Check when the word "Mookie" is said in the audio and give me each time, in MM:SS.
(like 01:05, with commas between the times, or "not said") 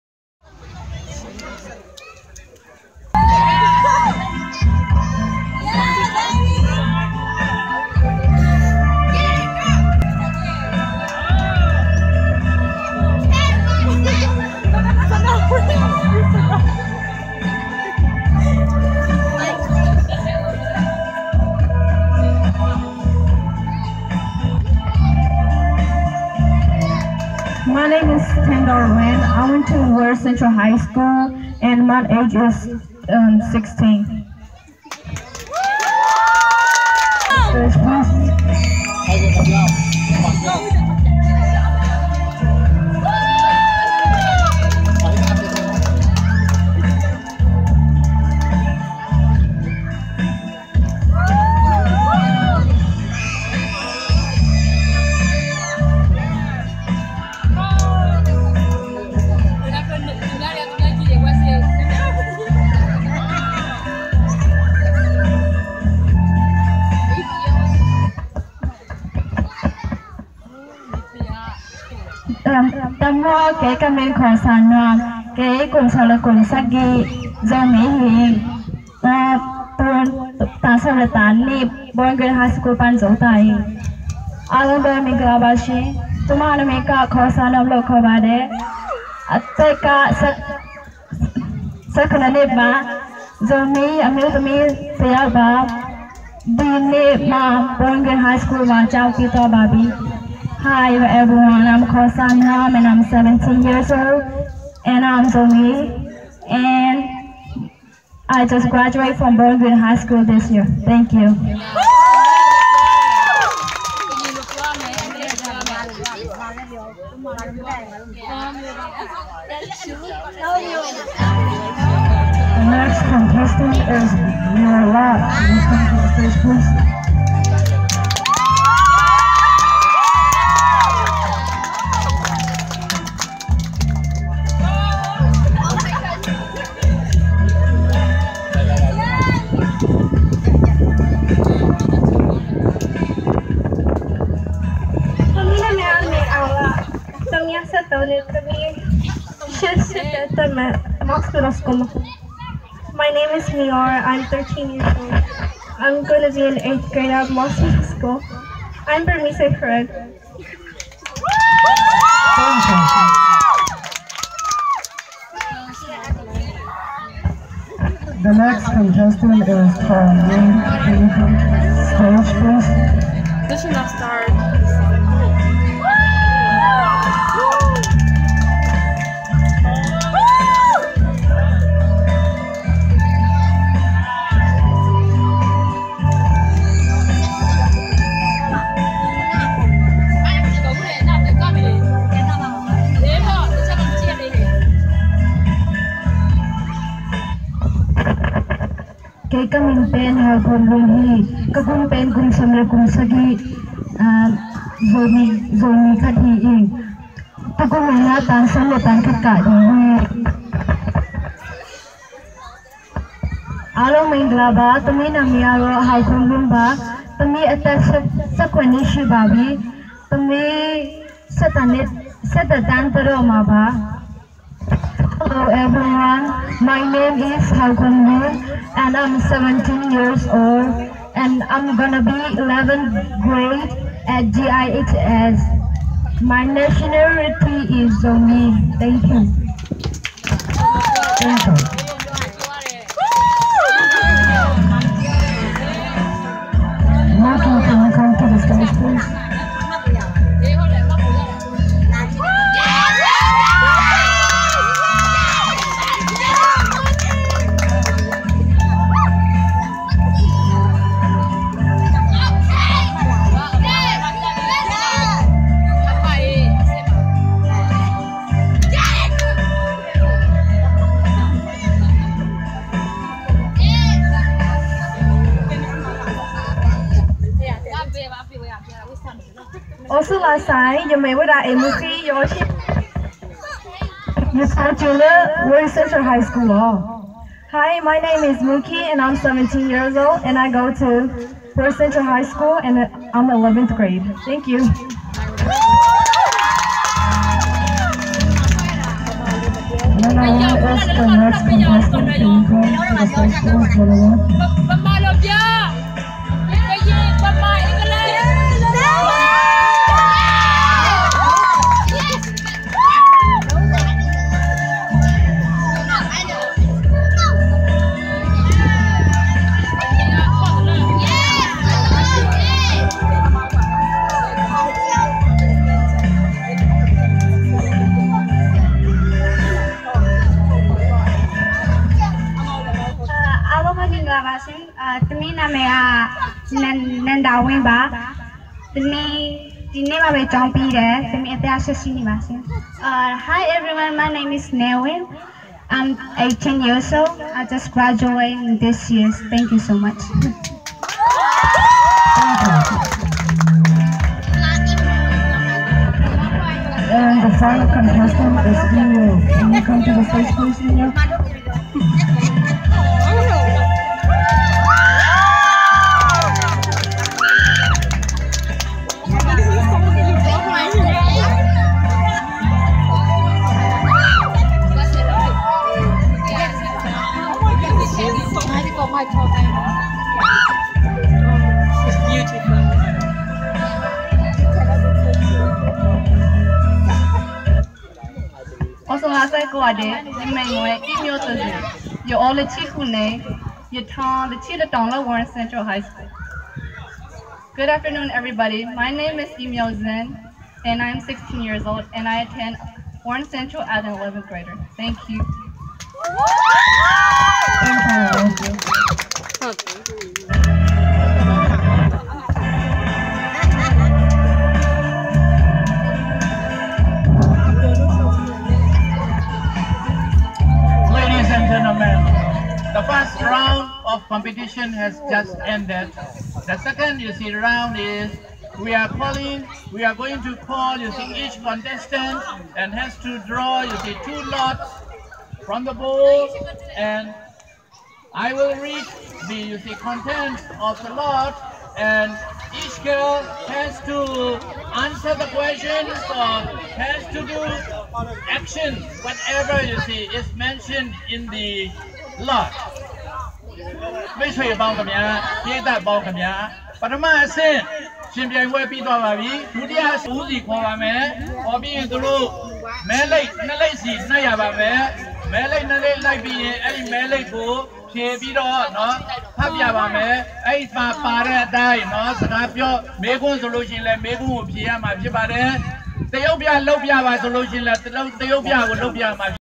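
04:48.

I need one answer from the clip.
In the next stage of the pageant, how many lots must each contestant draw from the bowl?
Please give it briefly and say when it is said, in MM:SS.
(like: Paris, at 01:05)
2, at 07:14.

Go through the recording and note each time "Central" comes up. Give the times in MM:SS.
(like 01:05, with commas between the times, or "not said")
00:30, 04:45, 04:51, 06:35, 06:43.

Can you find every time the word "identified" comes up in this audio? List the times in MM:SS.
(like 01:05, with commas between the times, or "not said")
not said.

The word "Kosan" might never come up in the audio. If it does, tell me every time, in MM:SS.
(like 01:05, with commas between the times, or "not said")
01:41.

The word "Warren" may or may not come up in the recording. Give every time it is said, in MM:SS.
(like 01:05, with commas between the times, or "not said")
06:35, 06:43.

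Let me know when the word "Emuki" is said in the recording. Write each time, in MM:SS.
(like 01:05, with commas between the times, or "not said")
04:41.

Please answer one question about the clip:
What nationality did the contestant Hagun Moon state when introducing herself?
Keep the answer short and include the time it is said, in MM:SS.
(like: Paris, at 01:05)
Zomi, at 03:58.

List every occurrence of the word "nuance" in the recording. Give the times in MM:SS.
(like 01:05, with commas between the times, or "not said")
not said.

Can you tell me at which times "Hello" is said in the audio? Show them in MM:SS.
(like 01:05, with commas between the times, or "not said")
03:45.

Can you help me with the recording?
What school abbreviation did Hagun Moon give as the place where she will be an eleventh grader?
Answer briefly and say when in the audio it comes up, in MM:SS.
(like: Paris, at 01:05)
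GIHS, at 03:54.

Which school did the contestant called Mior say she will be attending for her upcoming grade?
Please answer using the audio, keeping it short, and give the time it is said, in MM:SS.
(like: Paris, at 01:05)
Moscow School, at 02:37.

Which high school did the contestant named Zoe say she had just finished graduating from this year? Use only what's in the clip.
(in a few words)
Bowling High School.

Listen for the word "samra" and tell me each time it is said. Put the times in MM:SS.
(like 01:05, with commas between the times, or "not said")
03:22.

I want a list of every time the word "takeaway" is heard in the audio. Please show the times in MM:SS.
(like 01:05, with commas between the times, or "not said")
not said.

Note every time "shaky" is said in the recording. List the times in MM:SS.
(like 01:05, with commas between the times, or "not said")
not said.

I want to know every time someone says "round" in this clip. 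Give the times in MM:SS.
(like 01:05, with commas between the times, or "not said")
07:03, 07:07.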